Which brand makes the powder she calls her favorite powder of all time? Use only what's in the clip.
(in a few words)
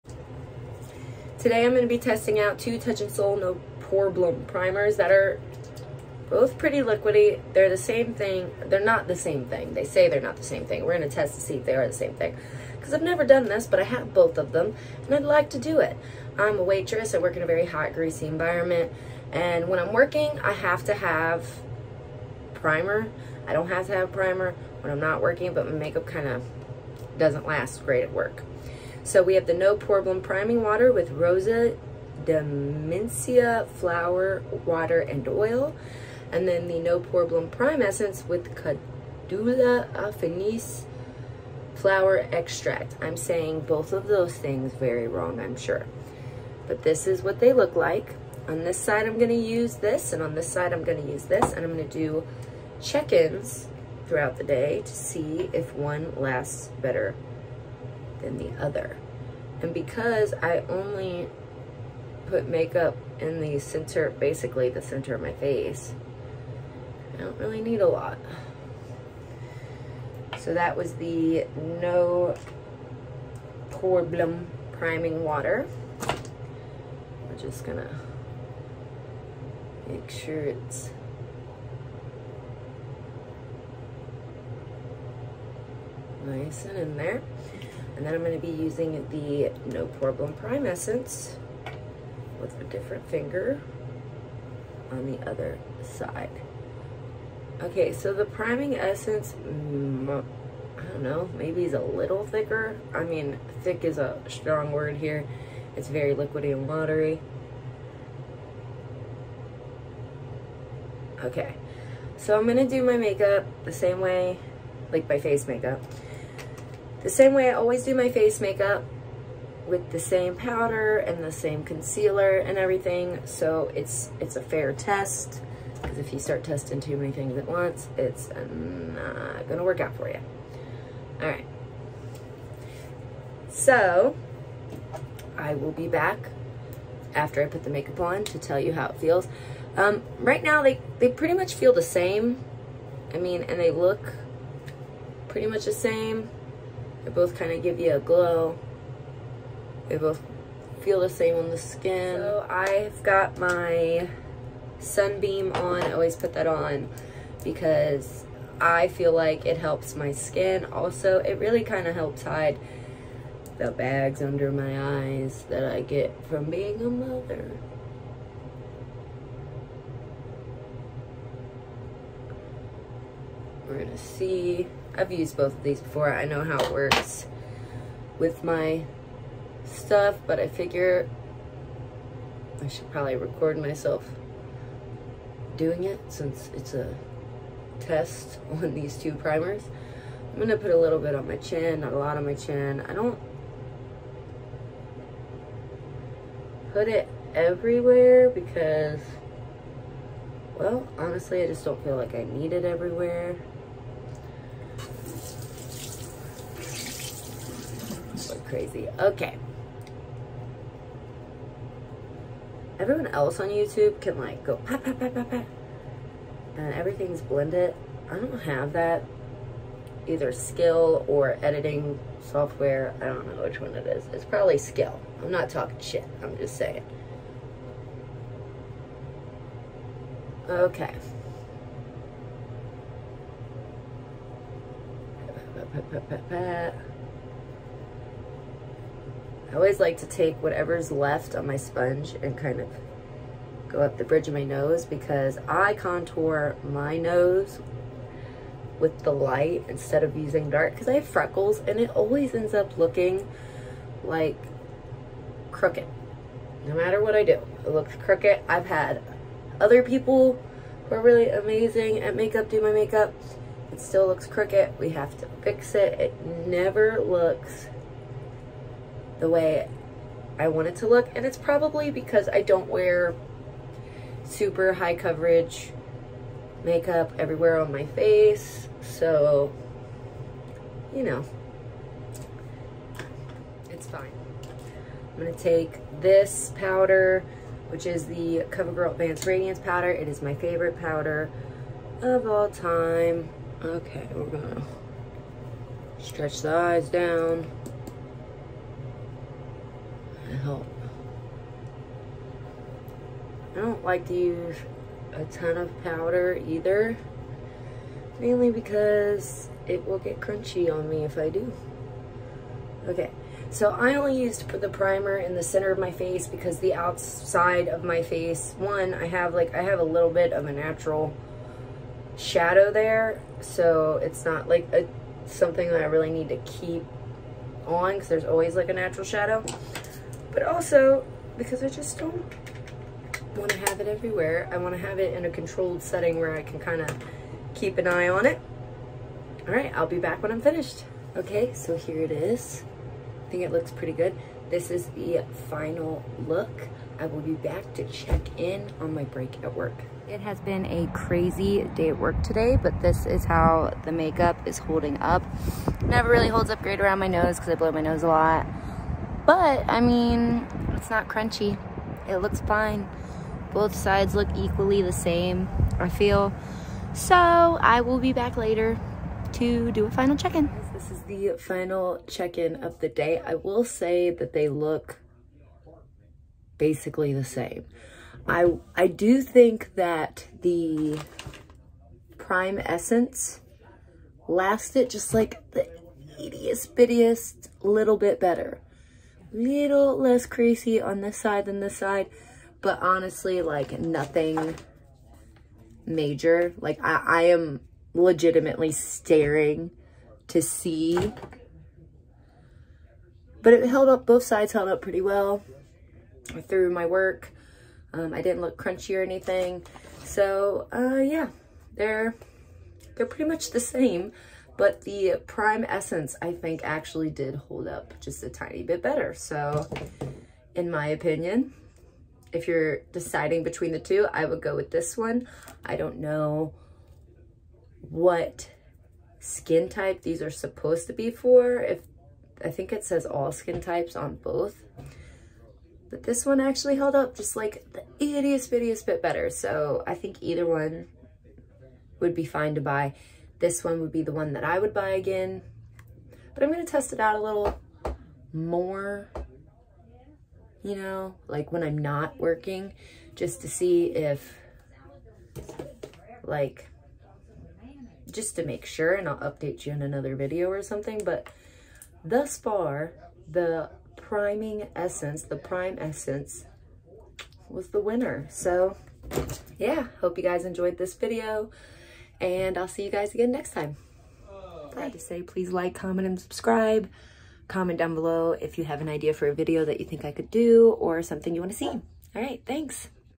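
CoverGirl.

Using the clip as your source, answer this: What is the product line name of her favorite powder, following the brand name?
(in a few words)
Advanced Radiance.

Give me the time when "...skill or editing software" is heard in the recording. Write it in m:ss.
3:40.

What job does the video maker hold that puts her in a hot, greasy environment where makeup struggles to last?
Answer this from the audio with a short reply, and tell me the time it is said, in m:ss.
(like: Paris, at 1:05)
waitress, at 0:16.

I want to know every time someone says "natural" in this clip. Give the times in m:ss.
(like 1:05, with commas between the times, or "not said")
5:20, 5:28.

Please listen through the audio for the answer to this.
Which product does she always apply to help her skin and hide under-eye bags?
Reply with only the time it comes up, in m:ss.
2:34.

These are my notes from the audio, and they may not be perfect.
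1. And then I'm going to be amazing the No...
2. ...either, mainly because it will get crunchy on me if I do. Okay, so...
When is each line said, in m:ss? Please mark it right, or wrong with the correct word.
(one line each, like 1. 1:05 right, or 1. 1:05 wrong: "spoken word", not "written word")
1. 1:28 wrong: "using", not "amazing"
2. 5:06 right.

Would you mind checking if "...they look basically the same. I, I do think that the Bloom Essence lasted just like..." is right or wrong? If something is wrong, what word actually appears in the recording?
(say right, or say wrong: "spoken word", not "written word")
wrong: "Prime", not "Bloom".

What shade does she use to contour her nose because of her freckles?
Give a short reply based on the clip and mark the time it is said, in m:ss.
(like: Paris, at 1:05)
light, at 4:09.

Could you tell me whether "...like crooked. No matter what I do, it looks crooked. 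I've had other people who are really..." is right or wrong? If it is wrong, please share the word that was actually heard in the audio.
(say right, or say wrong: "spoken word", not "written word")
right.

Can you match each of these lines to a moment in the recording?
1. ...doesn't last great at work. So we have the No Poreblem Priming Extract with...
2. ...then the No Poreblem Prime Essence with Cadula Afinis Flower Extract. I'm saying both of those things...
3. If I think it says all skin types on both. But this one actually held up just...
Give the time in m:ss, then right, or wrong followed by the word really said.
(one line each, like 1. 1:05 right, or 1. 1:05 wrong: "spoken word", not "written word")
1. 0:27 wrong: "Water", not "Extract"
2. 0:36 right
3. 7:11 right.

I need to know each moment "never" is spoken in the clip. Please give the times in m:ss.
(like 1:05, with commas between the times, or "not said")
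0:13, 4:26, 5:55.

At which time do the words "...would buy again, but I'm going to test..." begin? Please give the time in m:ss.
7:24.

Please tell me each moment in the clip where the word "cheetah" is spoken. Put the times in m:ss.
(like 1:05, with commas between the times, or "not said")
not said.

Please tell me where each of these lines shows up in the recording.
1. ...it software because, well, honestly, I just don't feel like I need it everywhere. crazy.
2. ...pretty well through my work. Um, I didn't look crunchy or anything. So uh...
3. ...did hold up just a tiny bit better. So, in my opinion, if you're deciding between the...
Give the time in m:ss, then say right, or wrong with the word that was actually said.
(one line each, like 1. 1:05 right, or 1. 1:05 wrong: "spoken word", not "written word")
1. 3:16 wrong: "everywhere", not "software"
2. 6:44 right
3. 6:57 right.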